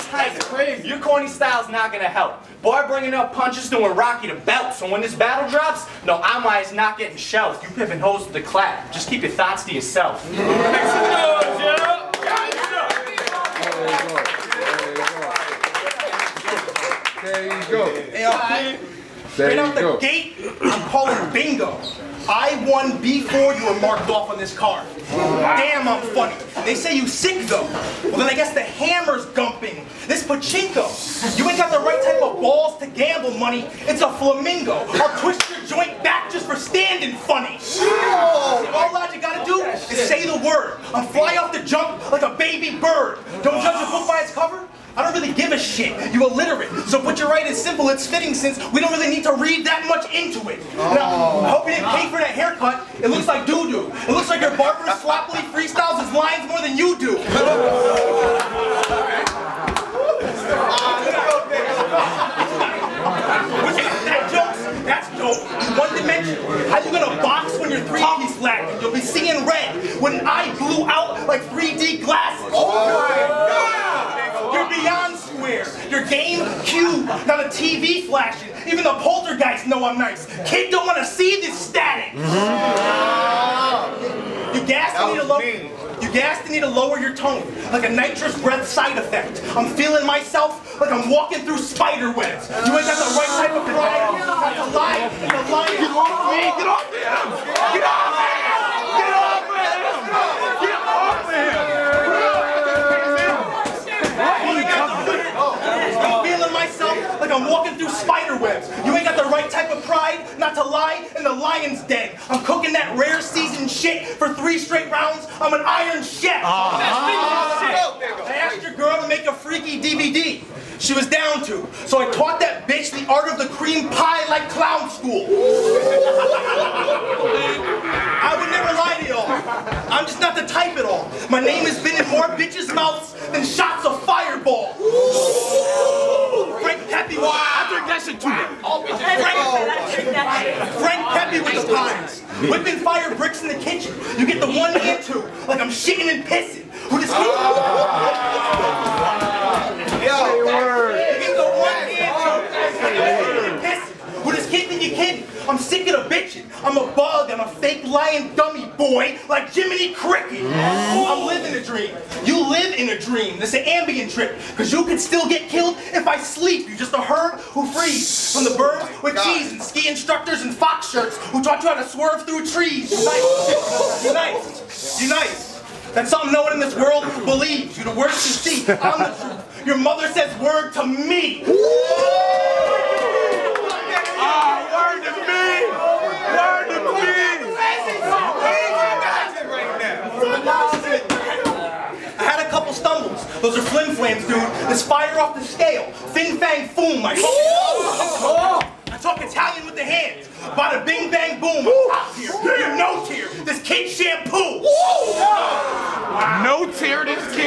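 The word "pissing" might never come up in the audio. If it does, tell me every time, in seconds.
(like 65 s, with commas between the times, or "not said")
146 s, 153 s.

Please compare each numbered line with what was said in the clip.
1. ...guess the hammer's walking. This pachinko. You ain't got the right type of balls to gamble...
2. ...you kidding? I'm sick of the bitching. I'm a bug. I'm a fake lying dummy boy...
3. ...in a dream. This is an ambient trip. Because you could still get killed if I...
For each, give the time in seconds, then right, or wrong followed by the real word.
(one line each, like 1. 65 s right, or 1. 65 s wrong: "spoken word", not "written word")
1. 28 s wrong: "gumping", not "walking"
2. 154 s right
3. 162 s right.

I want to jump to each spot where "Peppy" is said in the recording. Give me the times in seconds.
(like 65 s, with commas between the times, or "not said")
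136 s, 141 s.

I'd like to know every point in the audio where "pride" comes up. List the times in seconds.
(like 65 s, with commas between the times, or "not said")
93 s, 109 s.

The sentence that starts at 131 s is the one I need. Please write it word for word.
My name has been in more bitches' mouths than shots of fireball.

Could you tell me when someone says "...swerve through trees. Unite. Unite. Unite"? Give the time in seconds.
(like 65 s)
171 s.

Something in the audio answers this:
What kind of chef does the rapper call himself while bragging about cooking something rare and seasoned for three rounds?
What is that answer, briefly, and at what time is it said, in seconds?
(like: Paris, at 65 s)
iron chef, at 115 s.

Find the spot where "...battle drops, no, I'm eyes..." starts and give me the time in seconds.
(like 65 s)
5 s.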